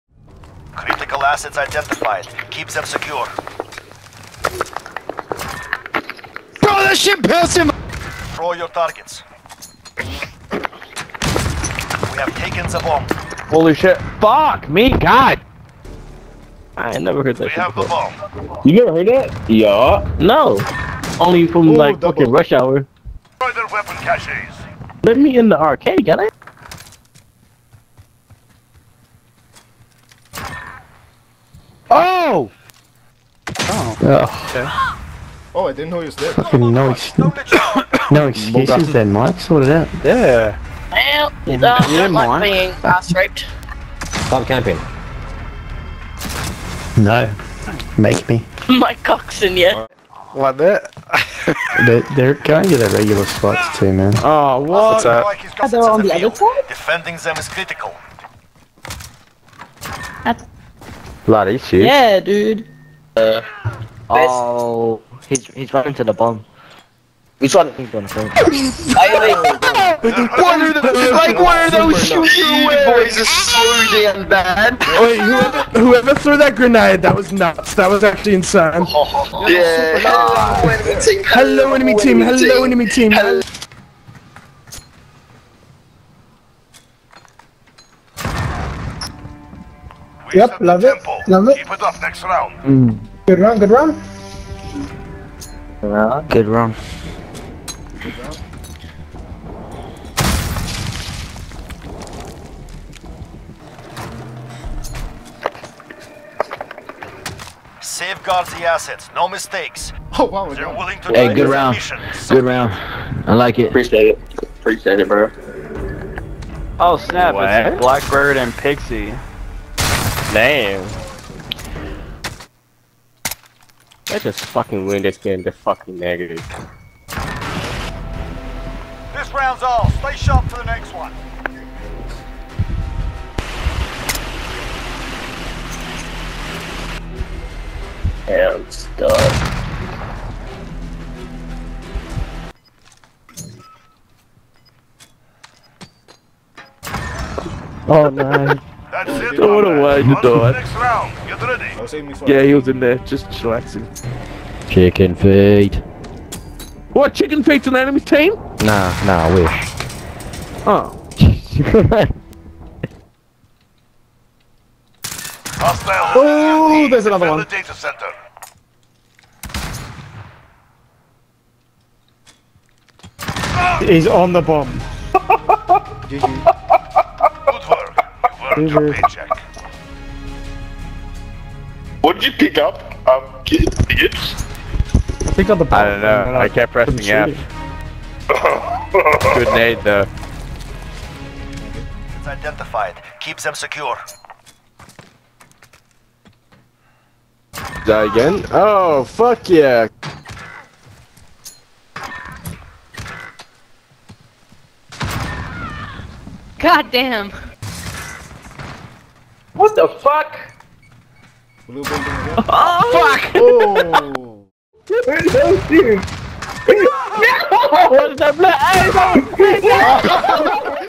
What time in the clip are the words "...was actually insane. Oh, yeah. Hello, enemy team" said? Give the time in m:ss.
1:17.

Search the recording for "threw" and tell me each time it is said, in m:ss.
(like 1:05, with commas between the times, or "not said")
1:16.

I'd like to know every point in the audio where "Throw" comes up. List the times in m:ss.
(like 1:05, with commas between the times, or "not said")
0:08, 2:29.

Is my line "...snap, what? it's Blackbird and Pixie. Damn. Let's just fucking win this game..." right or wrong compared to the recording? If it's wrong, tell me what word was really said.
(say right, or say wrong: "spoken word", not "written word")
right.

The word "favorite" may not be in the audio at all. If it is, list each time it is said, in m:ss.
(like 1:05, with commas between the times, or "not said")
not said.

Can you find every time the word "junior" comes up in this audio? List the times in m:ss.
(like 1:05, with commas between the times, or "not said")
not said.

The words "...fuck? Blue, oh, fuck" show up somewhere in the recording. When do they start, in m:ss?
3:29.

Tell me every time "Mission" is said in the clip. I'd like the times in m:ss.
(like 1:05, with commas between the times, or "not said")
1:51.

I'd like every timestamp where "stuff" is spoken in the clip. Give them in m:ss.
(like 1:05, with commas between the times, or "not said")
2:18.